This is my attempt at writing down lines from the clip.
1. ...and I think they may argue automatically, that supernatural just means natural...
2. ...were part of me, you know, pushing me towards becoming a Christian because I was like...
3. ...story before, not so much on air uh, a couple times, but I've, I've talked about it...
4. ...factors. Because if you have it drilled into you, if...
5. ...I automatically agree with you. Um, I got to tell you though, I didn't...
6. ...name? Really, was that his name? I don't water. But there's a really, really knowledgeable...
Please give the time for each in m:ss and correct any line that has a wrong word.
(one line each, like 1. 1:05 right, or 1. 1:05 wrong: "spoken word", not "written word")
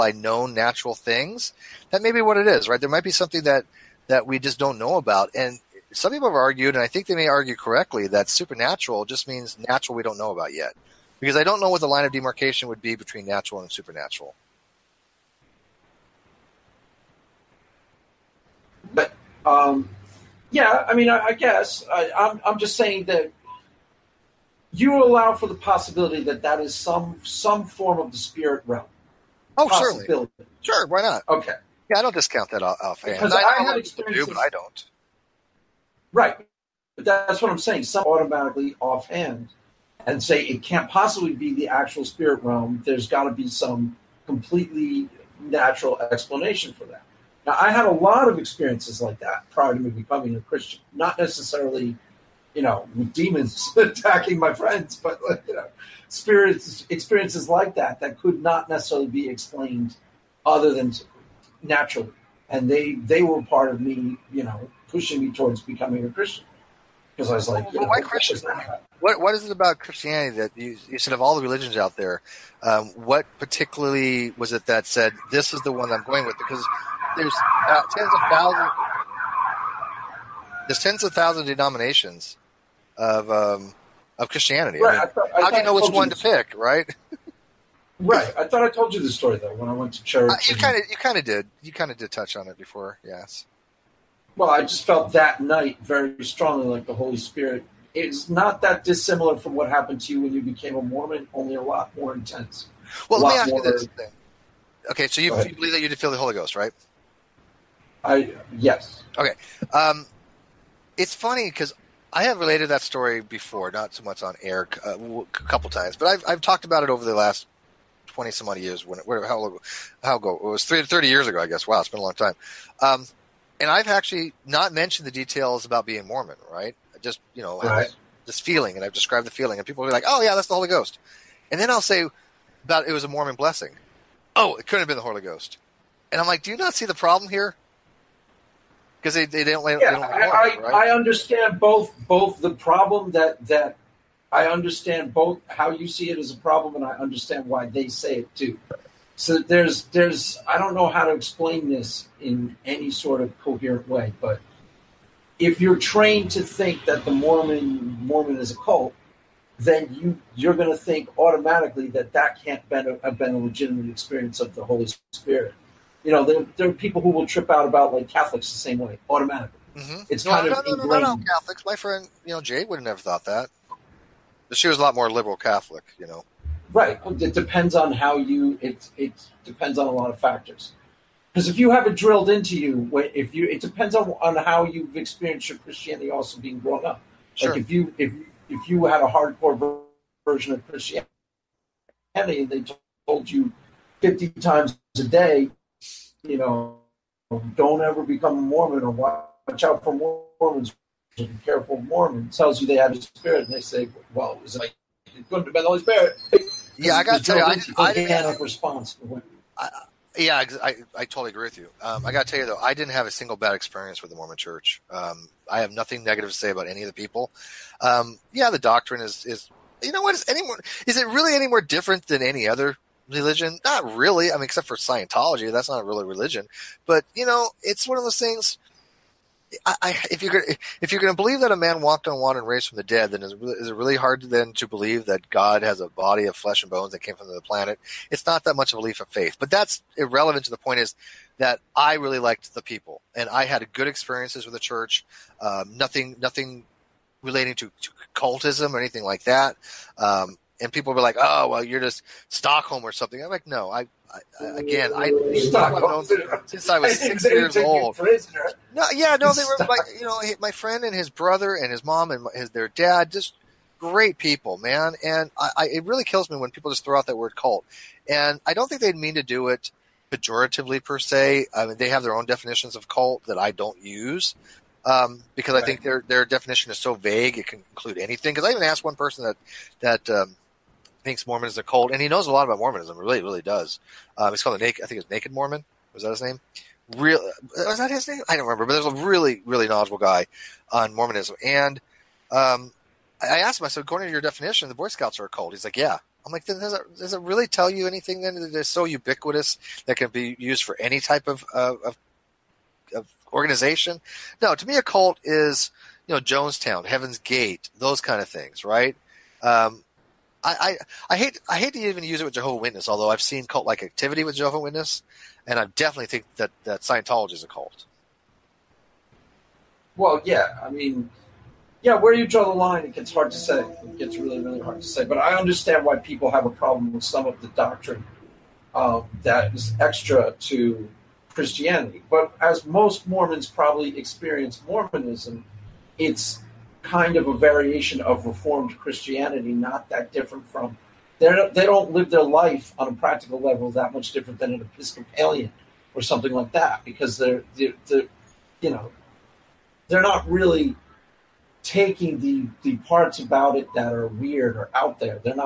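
1. 0:06 wrong: "correctly", not "automatically"
2. 1:03 right
3. 1:52 right
4. 3:00 right
5. 3:30 wrong: "totally", not "automatically"
6. 4:46 wrong: "remember", not "water".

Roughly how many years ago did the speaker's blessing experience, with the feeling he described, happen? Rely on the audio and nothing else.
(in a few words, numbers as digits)
30.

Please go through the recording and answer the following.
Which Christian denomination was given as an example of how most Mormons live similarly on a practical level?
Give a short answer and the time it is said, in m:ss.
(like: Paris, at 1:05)
Episcopalian, at 5:44.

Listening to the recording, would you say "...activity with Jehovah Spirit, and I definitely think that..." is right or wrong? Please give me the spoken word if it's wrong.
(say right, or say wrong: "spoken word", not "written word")
wrong: "Witness", not "Spirit".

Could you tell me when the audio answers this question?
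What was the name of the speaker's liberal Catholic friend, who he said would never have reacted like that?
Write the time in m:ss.
2:52.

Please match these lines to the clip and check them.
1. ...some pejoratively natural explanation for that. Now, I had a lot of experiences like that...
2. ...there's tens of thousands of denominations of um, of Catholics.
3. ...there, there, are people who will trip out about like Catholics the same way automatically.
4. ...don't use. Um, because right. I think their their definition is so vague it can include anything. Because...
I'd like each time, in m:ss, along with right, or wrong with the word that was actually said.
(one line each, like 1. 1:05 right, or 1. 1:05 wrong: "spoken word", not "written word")
1. 0:43 wrong: "completely", not "pejoratively"
2. 1:20 wrong: "Christianity", not "Catholics"
3. 2:46 right
4. 4:33 right.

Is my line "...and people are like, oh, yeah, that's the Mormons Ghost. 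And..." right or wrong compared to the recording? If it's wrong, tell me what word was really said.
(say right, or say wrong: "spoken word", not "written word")
wrong: "Holy", not "Mormons".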